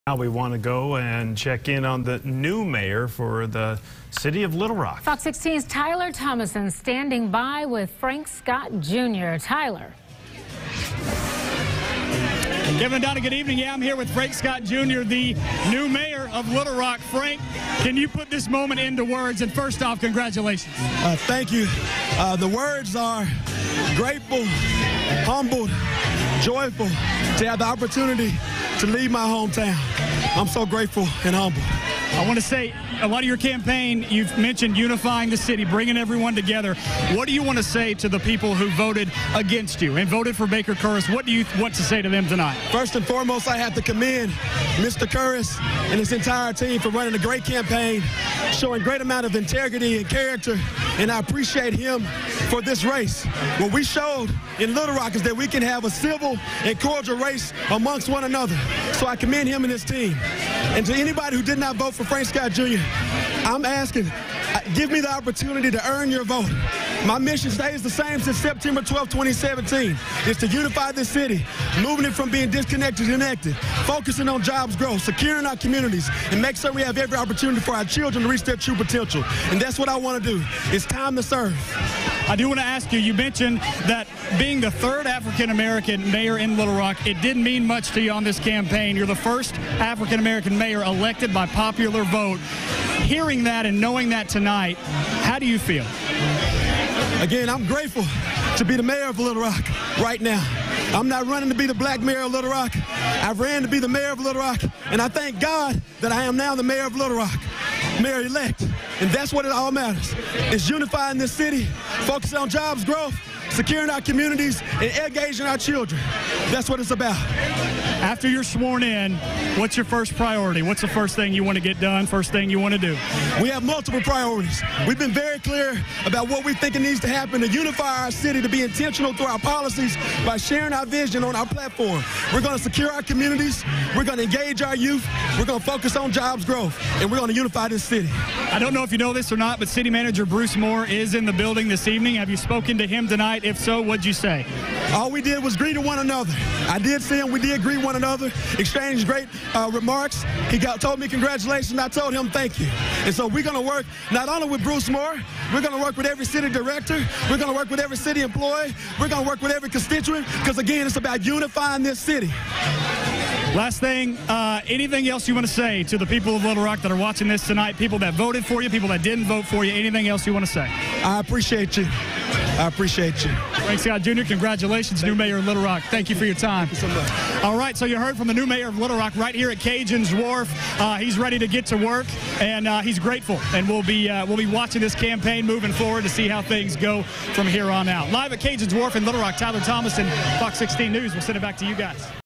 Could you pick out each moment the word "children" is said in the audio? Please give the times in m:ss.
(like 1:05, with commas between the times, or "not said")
1:17, 1:55.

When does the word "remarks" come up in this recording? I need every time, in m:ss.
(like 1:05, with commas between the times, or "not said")
2:29.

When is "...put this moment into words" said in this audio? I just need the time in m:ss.
0:18.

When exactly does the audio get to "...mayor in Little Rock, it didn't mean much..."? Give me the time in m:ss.
1:26.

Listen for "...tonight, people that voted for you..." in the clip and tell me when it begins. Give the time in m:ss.
2:47.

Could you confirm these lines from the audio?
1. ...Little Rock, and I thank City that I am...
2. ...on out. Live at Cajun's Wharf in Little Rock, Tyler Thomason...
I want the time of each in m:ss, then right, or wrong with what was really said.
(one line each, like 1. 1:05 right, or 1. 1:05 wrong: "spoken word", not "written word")
1. 1:44 wrong: "God", not "City"
2. 3:07 right.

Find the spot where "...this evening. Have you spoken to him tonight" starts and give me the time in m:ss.
2:21.